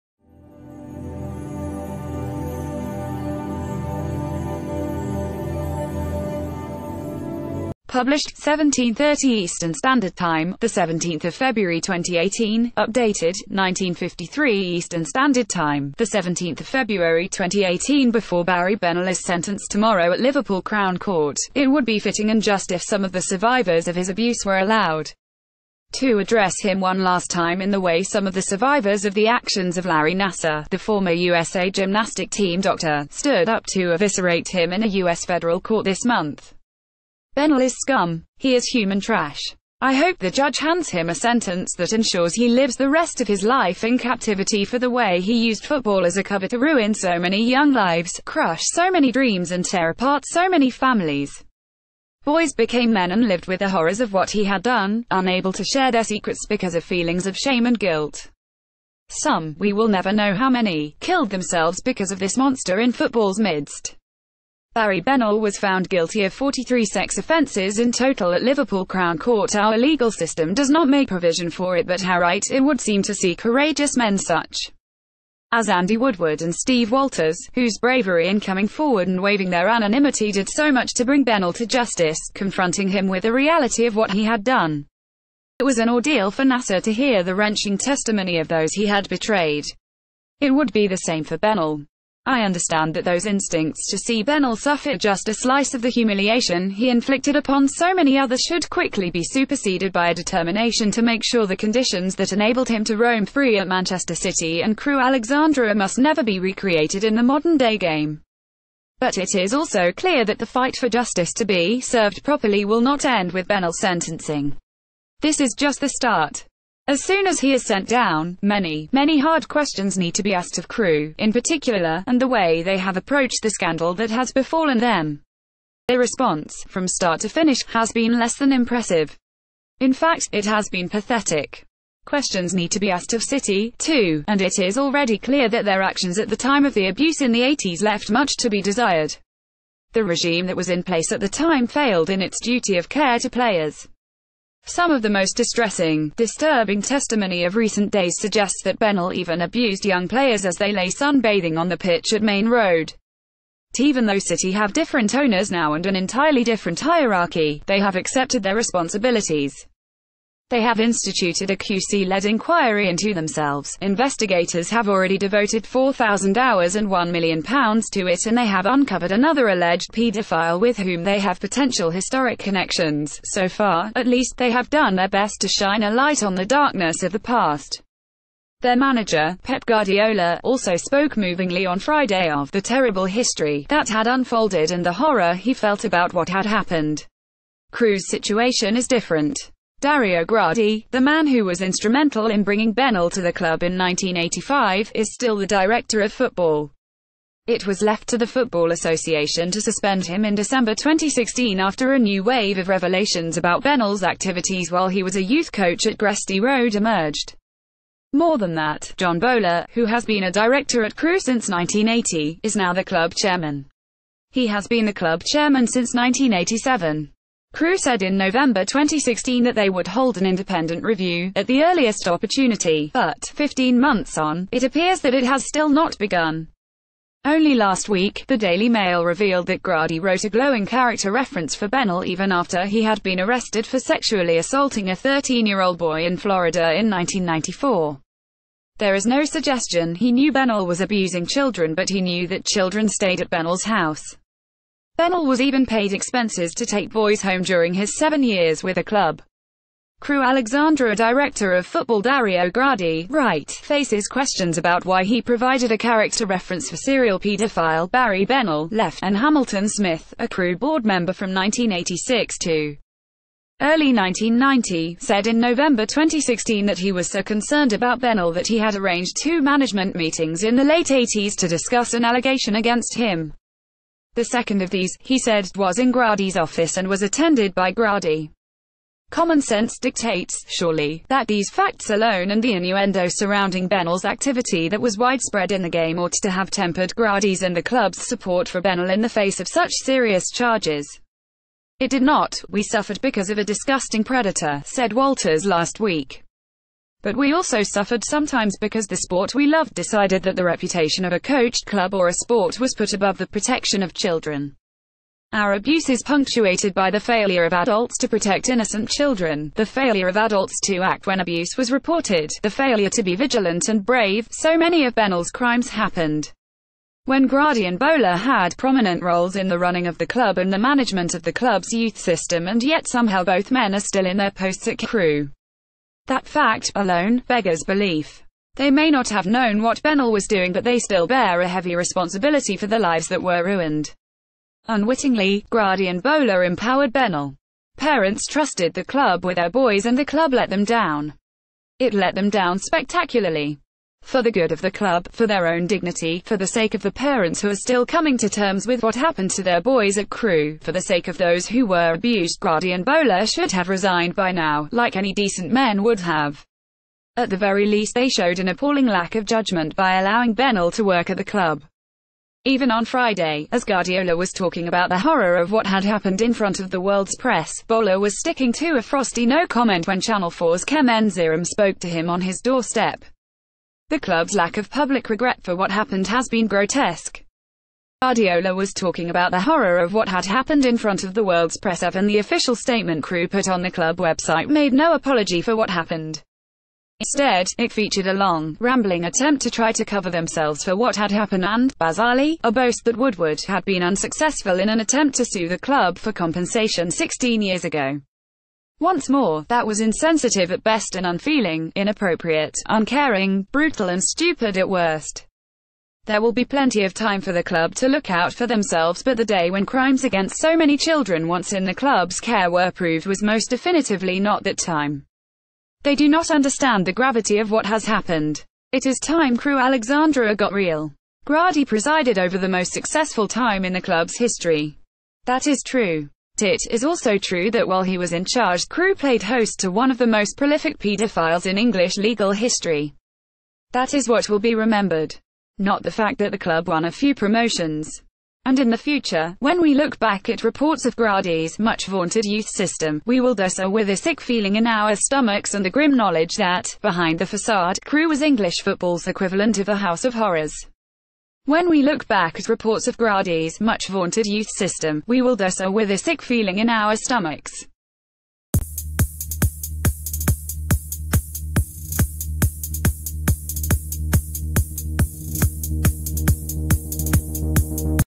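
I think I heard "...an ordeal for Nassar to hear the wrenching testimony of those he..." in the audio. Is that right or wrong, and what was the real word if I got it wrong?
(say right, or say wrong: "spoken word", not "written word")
right.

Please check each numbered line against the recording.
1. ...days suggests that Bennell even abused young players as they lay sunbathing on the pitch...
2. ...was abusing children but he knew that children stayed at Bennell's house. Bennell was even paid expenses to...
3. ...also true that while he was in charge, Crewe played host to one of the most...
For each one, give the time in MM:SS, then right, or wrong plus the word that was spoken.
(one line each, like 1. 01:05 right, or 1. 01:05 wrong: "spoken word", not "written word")
1. 02:27 right
2. 04:00 right
3. 07:06 right.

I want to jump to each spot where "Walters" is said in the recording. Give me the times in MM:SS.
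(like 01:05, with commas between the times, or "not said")
01:16, 04:54.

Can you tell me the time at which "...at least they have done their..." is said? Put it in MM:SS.
02:53.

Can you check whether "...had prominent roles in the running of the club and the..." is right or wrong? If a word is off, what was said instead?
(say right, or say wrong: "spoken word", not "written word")
right.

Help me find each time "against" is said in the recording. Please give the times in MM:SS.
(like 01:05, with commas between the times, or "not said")
04:32, 06:50.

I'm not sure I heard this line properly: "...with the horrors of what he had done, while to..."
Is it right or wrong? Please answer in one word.
wrong.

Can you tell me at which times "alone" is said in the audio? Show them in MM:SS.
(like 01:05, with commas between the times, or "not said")
04:41, 05:26.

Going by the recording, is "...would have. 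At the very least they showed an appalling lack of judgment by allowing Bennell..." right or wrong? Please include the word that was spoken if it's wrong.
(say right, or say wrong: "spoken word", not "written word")
right.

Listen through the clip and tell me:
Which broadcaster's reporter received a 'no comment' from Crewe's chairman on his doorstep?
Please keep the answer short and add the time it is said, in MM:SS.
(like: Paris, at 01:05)
Channel 4, at 06:10.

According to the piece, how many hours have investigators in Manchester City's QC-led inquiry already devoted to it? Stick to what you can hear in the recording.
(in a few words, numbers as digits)
4,000.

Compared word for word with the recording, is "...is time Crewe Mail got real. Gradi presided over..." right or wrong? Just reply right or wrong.
wrong.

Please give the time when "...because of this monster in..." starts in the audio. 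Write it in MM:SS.
01:01.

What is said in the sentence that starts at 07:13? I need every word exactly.
That is what will be remembered, not the fact that the club won a few promotions.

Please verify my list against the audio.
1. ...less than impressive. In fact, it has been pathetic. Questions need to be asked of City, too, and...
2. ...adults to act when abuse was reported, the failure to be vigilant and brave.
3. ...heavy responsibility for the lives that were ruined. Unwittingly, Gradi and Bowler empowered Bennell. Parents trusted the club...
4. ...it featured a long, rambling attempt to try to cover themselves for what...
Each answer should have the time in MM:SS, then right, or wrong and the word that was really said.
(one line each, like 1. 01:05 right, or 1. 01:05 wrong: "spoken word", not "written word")
1. 02:08 right
2. 05:10 right
3. 05:31 right
4. 06:27 right.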